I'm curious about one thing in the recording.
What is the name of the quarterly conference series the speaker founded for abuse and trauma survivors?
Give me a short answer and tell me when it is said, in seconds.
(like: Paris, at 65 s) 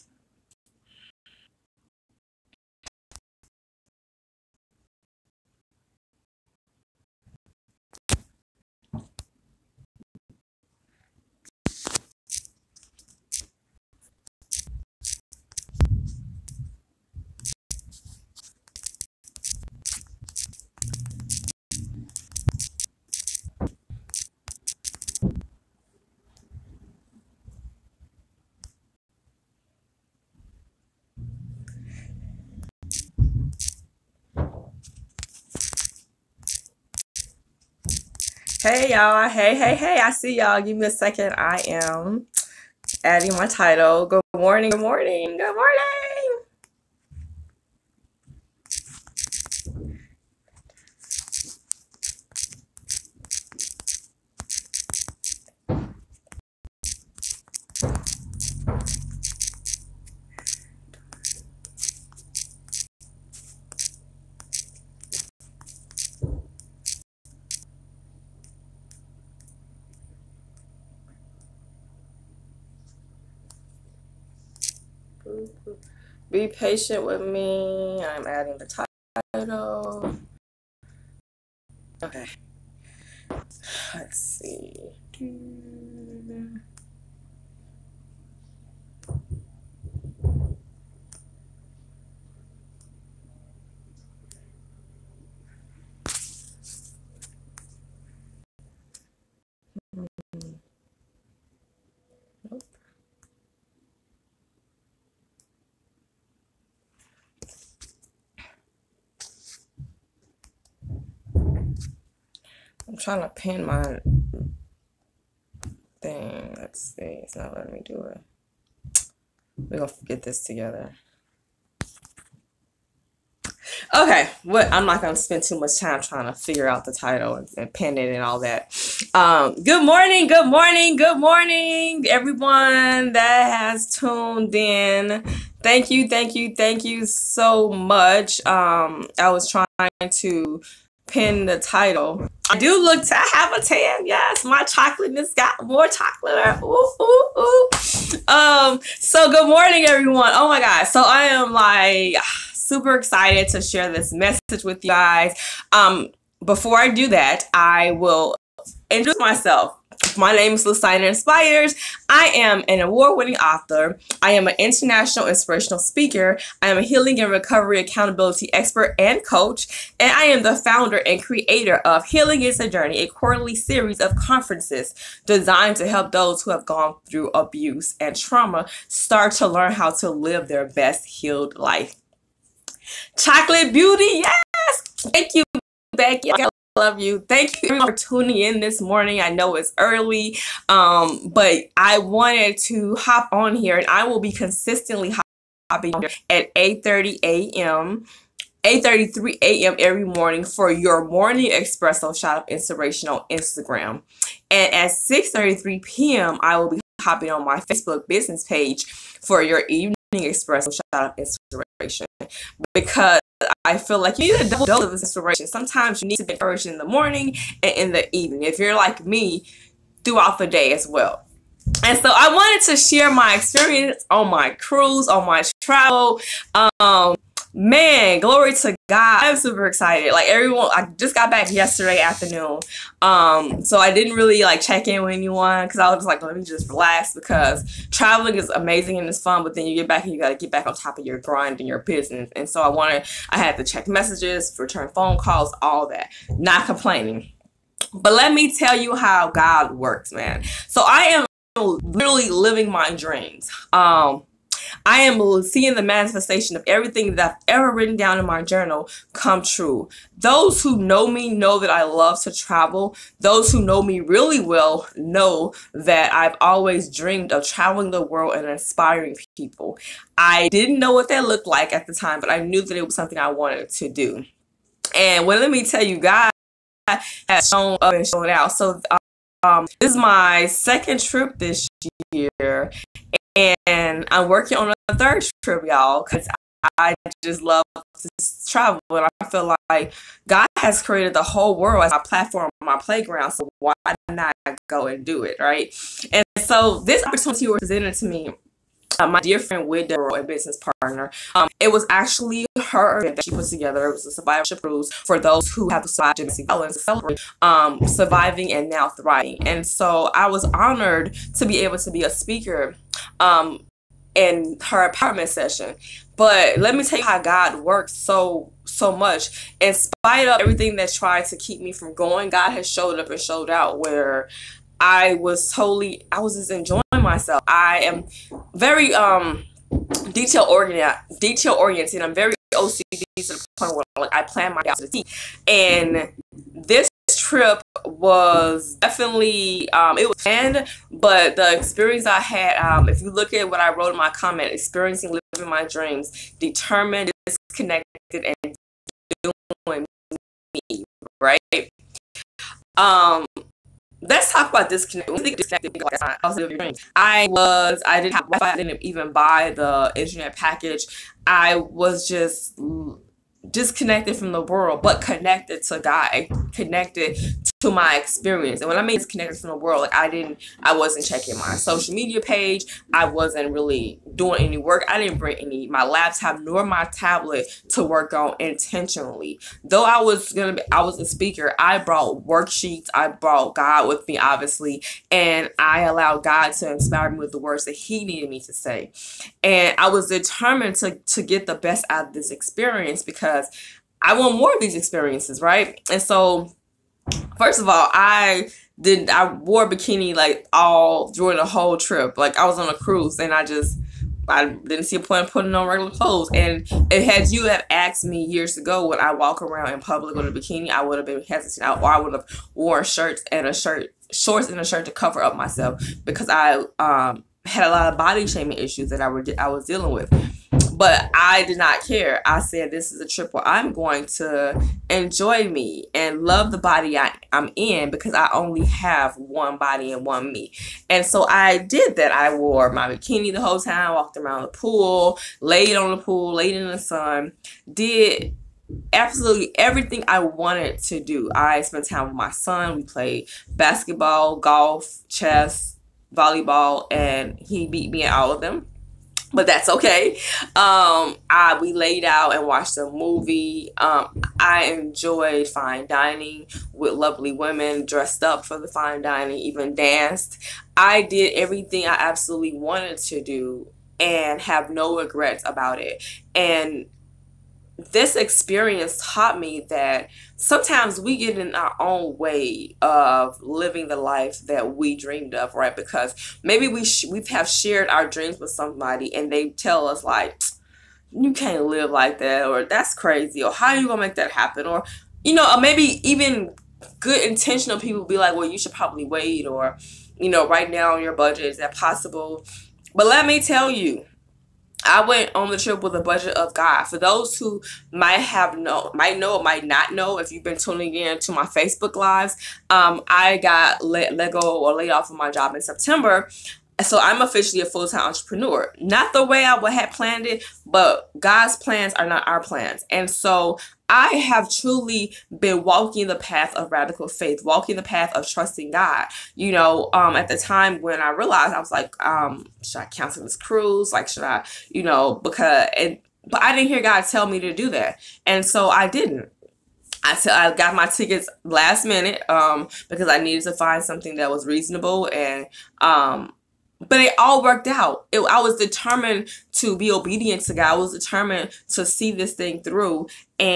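Healing is a Journey, at 172 s.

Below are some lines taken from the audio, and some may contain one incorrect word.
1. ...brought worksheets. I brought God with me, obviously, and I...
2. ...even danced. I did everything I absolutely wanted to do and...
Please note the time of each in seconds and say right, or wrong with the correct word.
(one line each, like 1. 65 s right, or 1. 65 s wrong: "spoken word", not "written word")
1. 381 s right
2. 459 s right.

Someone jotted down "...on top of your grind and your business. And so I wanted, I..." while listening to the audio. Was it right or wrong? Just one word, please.
right.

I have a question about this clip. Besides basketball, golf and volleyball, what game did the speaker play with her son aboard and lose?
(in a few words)
Chess.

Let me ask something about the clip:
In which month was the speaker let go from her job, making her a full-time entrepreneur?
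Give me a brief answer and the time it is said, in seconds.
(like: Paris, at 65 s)
September, at 505 s.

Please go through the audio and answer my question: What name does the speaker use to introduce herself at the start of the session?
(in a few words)
Listiner Inspires.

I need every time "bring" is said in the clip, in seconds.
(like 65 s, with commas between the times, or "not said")
375 s.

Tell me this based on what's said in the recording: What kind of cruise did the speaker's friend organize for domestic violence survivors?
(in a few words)
Survivorship cruise.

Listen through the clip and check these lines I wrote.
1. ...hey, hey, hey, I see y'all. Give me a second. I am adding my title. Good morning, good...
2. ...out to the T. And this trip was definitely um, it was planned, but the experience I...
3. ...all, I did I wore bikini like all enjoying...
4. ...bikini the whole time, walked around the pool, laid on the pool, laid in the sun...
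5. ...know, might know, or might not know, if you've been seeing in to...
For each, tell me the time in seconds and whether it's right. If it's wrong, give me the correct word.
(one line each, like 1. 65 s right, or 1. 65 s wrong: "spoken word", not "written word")
1. 39 s right
2. 334 s right
3. 397 s wrong: "during", not "enjoying"
4. 432 s right
5. 498 s wrong: "tuning", not "seeing".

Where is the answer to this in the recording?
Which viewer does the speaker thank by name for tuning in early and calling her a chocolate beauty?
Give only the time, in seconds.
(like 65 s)
185 s.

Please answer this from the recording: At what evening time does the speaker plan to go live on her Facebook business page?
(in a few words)
6:33 p.m.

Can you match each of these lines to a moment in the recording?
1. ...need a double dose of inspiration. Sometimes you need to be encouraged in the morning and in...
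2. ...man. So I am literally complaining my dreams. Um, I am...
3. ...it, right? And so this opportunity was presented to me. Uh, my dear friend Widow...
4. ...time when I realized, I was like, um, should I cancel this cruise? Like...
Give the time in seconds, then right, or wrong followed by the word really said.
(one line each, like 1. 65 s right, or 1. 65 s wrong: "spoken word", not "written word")
1. 214 s right
2. 250 s wrong: "living", not "complaining"
3. 295 s right
4. 520 s right.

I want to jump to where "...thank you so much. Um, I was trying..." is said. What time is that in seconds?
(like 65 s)
136 s.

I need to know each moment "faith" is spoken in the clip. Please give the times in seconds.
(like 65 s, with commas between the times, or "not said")
517 s.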